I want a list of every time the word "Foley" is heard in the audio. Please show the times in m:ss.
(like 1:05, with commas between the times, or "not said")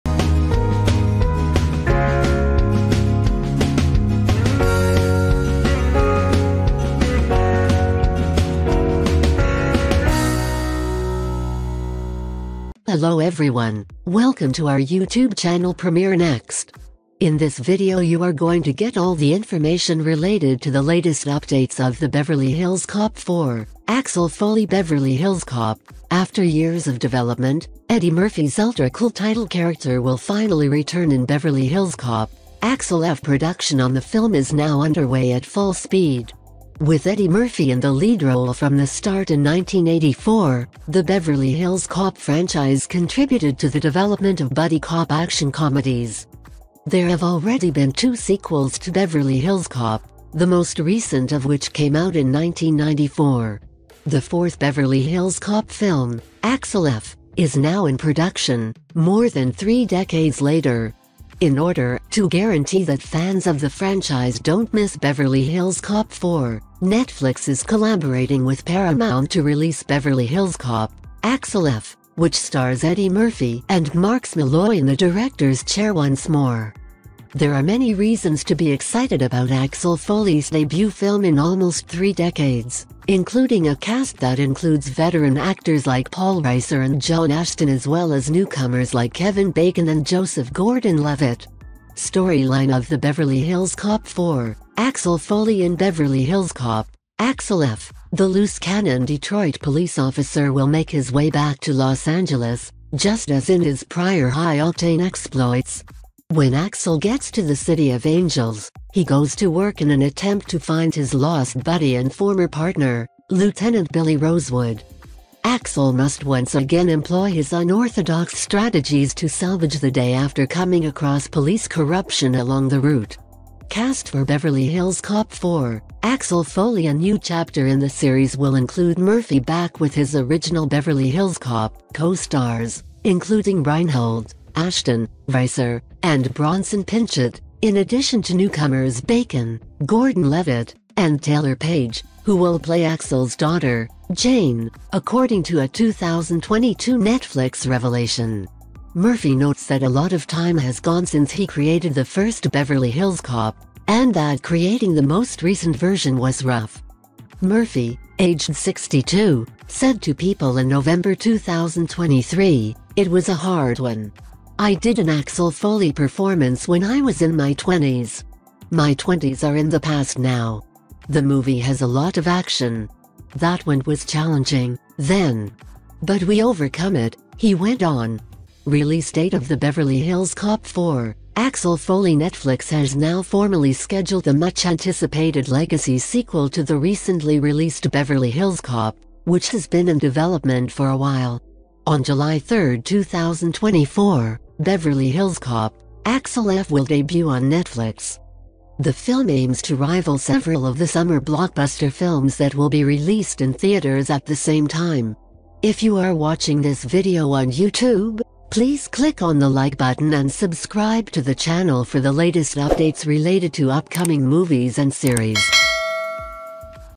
0:24, 1:19, 1:35, 2:06, 2:45, 3:01.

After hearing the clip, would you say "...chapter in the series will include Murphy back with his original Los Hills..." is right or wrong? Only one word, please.
wrong.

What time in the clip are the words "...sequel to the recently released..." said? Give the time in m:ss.
3:05.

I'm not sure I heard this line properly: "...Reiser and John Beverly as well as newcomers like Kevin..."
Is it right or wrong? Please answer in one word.
wrong.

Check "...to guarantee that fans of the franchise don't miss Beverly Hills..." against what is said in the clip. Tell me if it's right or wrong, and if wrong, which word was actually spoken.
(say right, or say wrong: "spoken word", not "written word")
right.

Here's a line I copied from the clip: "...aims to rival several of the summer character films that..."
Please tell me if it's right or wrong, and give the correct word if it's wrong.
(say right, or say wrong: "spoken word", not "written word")
wrong: "blockbuster", not "character".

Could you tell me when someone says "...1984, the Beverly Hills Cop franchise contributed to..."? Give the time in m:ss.
0:39.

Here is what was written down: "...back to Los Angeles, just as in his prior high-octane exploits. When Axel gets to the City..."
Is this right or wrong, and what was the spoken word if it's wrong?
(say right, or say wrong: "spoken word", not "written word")
right.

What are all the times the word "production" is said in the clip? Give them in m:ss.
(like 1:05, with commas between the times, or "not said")
0:33, 0:57.